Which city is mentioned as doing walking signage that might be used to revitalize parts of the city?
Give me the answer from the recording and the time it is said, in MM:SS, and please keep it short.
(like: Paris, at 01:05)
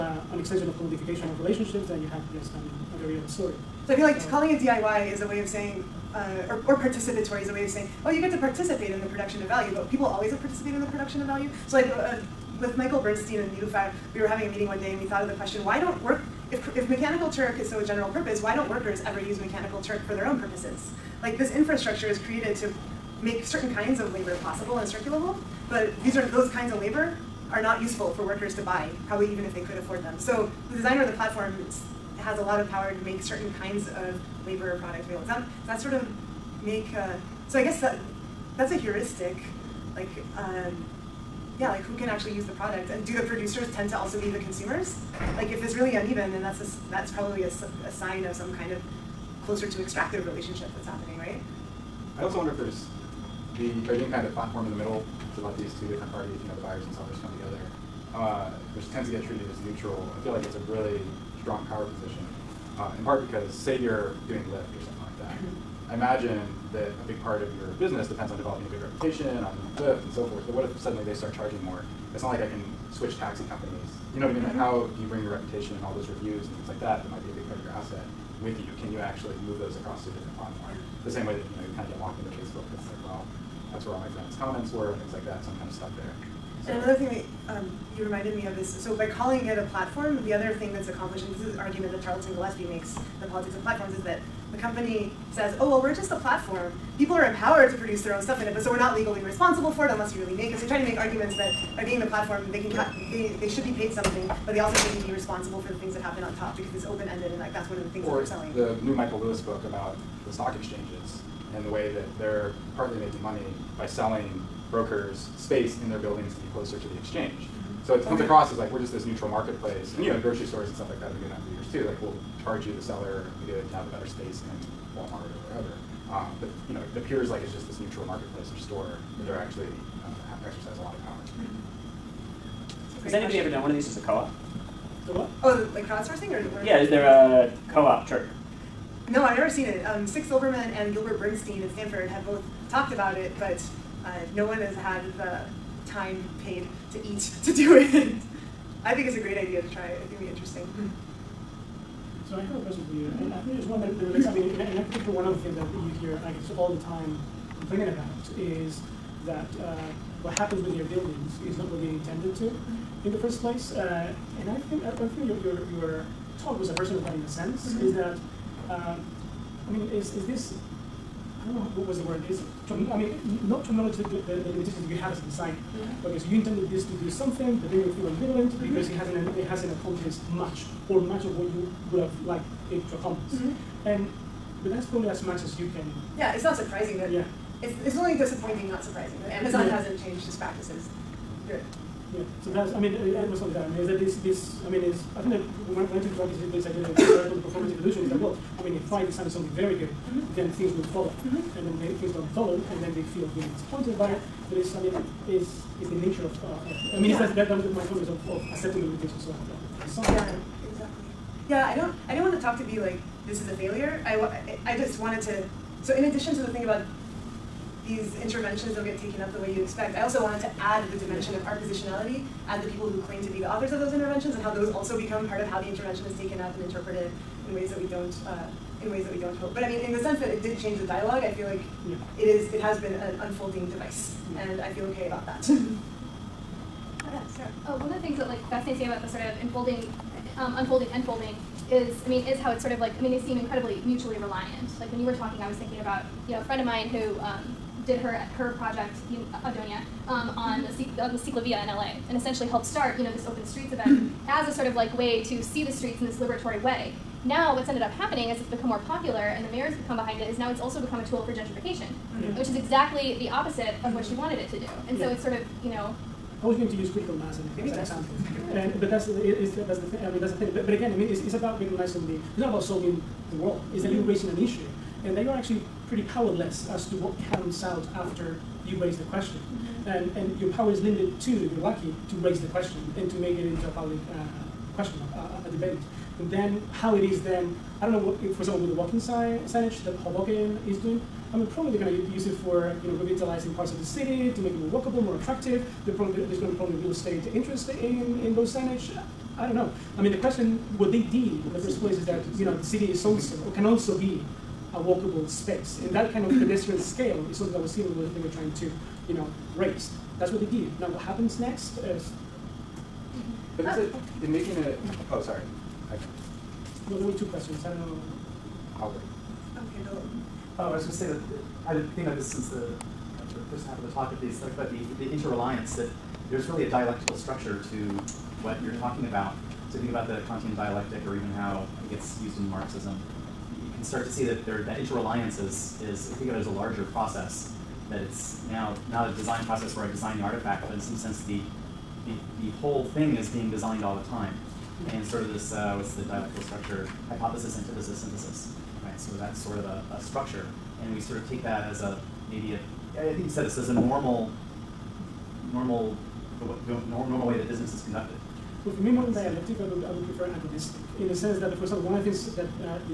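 Hoboken, at 04:49.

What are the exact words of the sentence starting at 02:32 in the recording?
So I have a question for you, and I think there's one that, relates.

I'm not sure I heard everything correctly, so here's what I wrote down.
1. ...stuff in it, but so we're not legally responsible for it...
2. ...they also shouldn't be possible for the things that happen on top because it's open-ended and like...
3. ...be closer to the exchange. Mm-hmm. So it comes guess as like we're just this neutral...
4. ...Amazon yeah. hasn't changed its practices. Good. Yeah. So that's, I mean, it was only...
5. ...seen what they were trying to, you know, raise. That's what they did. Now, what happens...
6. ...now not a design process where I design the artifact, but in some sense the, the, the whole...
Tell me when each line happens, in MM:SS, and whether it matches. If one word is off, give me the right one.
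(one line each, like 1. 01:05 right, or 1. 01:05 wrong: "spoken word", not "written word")
1. 01:38 right
2. 01:44 wrong: "responsible", not "possible"
3. 01:56 wrong: "across", not "guess"
4. 03:09 right
5. 05:07 right
6. 05:38 right.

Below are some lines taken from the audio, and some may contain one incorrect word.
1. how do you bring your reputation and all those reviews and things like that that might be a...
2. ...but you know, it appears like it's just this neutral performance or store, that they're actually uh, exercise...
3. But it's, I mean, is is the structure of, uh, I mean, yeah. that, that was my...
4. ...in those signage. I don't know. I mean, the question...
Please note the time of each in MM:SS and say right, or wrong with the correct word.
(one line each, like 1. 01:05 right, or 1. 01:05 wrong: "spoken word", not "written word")
1. 01:14 right
2. 02:06 wrong: "marketplace", not "performance"
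3. 03:24 wrong: "nature", not "structure"
4. 04:58 right.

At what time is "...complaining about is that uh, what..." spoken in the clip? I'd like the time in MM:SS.
02:37.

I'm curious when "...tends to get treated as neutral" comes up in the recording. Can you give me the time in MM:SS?
00:58.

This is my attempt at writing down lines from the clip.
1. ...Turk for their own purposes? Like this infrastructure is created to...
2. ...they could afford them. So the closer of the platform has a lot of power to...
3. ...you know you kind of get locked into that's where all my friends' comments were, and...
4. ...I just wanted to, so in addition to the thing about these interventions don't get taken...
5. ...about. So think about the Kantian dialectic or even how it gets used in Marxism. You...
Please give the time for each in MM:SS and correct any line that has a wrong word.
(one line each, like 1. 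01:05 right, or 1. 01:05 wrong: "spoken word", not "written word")
1. 00:19 right
2. 00:29 wrong: "designer", not "closer"
3. 01:21 right
4. 03:34 right
5. 05:29 right.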